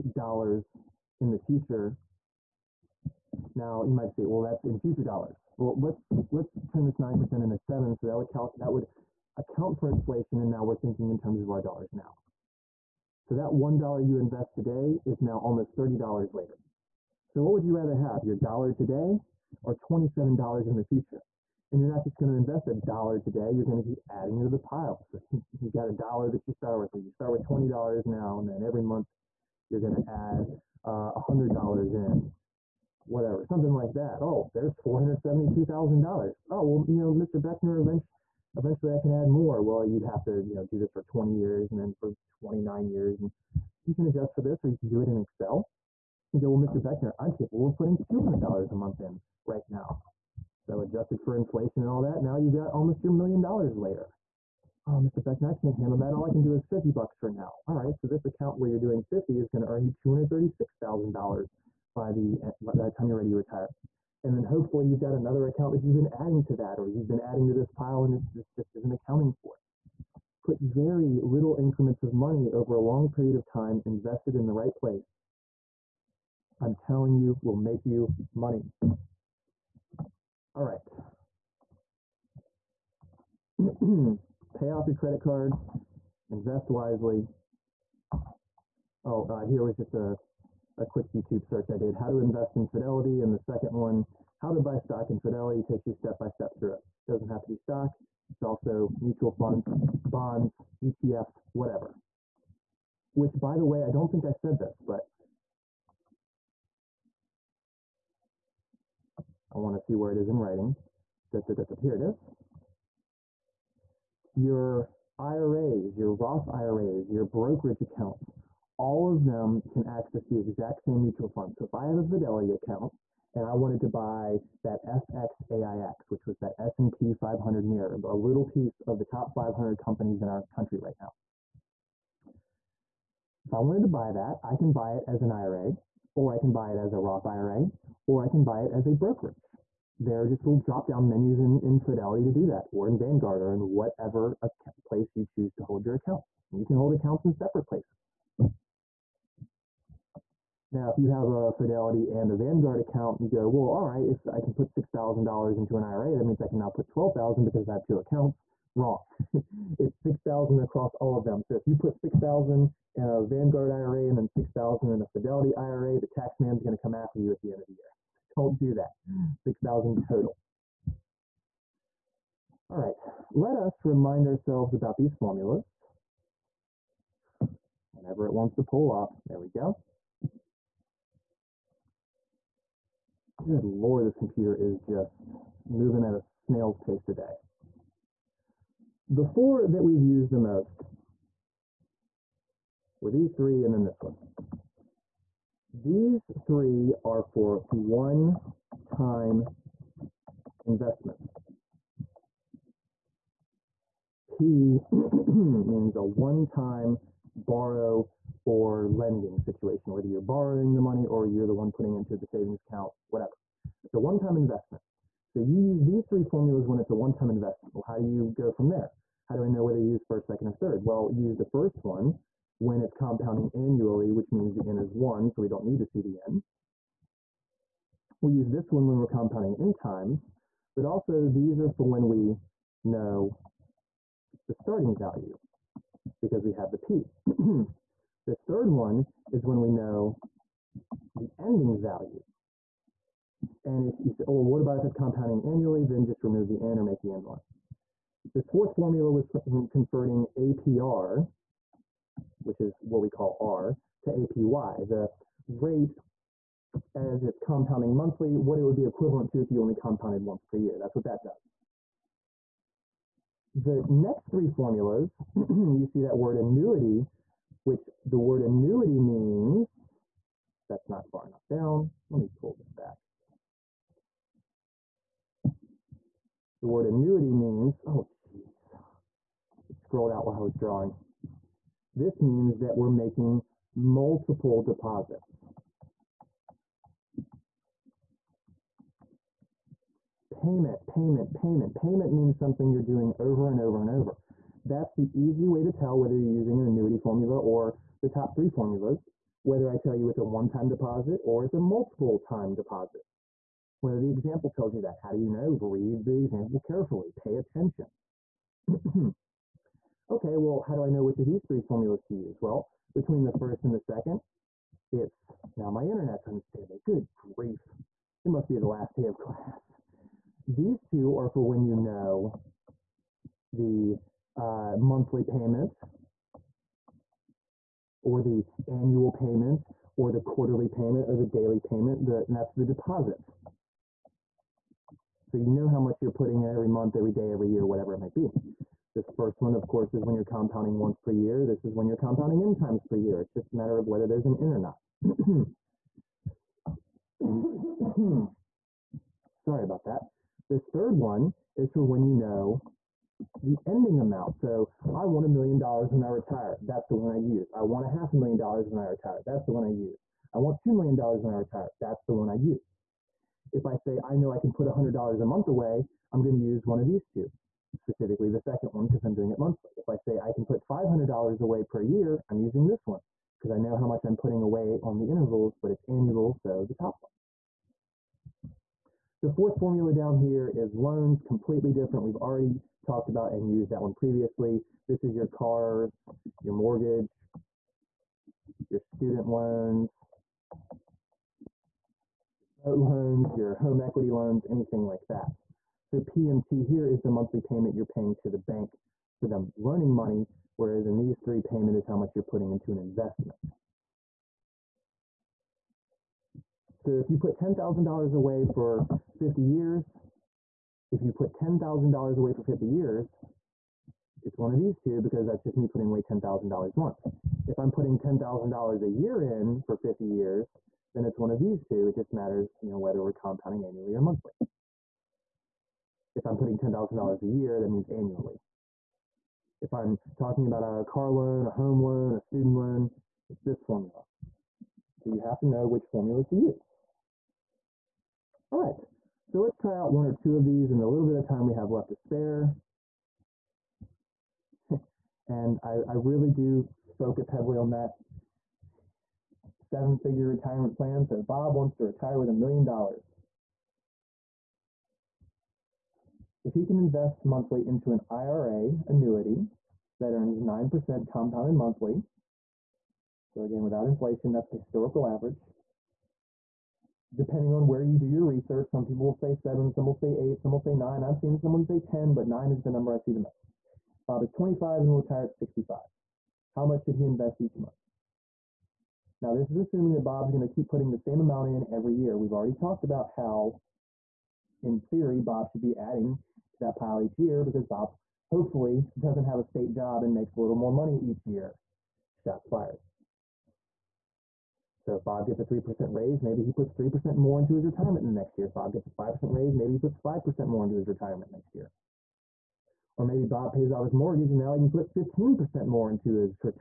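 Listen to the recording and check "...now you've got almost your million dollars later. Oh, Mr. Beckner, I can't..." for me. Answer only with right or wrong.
right.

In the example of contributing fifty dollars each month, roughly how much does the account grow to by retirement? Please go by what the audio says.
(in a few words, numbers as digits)
$236,000.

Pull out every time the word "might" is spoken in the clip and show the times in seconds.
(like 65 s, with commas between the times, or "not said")
3 s, 337 s.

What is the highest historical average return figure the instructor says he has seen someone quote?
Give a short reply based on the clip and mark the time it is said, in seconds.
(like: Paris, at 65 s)
10%, at 471 s.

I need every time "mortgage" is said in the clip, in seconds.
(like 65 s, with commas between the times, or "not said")
386 s, 503 s.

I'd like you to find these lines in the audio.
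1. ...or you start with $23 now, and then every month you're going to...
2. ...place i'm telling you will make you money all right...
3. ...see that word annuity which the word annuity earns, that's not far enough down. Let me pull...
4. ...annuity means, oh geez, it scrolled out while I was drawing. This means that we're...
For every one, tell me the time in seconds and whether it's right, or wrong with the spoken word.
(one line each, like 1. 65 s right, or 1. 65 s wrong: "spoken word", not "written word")
1. 26 s wrong: "20", not "23"
2. 74 s right
3. 265 s wrong: "means", not "earns"
4. 276 s right.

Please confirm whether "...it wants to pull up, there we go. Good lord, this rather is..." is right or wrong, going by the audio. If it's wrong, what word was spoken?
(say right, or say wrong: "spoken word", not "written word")
wrong: "computer", not "rather".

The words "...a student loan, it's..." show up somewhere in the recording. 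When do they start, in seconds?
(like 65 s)
432 s.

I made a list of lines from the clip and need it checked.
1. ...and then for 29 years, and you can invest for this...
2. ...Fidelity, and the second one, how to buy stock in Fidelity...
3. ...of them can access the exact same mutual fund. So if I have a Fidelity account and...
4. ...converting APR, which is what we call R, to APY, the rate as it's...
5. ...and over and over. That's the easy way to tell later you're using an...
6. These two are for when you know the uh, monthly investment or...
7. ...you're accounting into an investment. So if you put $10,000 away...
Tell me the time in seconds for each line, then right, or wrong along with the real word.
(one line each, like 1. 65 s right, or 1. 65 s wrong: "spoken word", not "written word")
1. 41 s wrong: "adjust", not "invest"
2. 92 s right
3. 119 s right
4. 249 s right
5. 293 s wrong: "whether", not "later"
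6. 320 s wrong: "payment", not "investment"
7. 402 s wrong: "putting", not "accounting".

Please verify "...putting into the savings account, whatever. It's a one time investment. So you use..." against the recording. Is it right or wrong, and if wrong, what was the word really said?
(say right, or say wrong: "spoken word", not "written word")
right.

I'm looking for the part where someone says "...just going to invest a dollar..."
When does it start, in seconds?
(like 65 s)
22 s.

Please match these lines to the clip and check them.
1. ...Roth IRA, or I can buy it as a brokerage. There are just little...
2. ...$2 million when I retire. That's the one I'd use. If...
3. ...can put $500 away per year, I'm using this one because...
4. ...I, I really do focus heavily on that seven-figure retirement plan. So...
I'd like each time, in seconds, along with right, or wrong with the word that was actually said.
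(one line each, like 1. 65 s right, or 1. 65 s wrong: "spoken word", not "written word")
1. 136 s right
2. 360 s right
3. 370 s right
4. 445 s right.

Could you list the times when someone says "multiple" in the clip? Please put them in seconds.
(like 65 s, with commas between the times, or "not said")
283 s, 301 s.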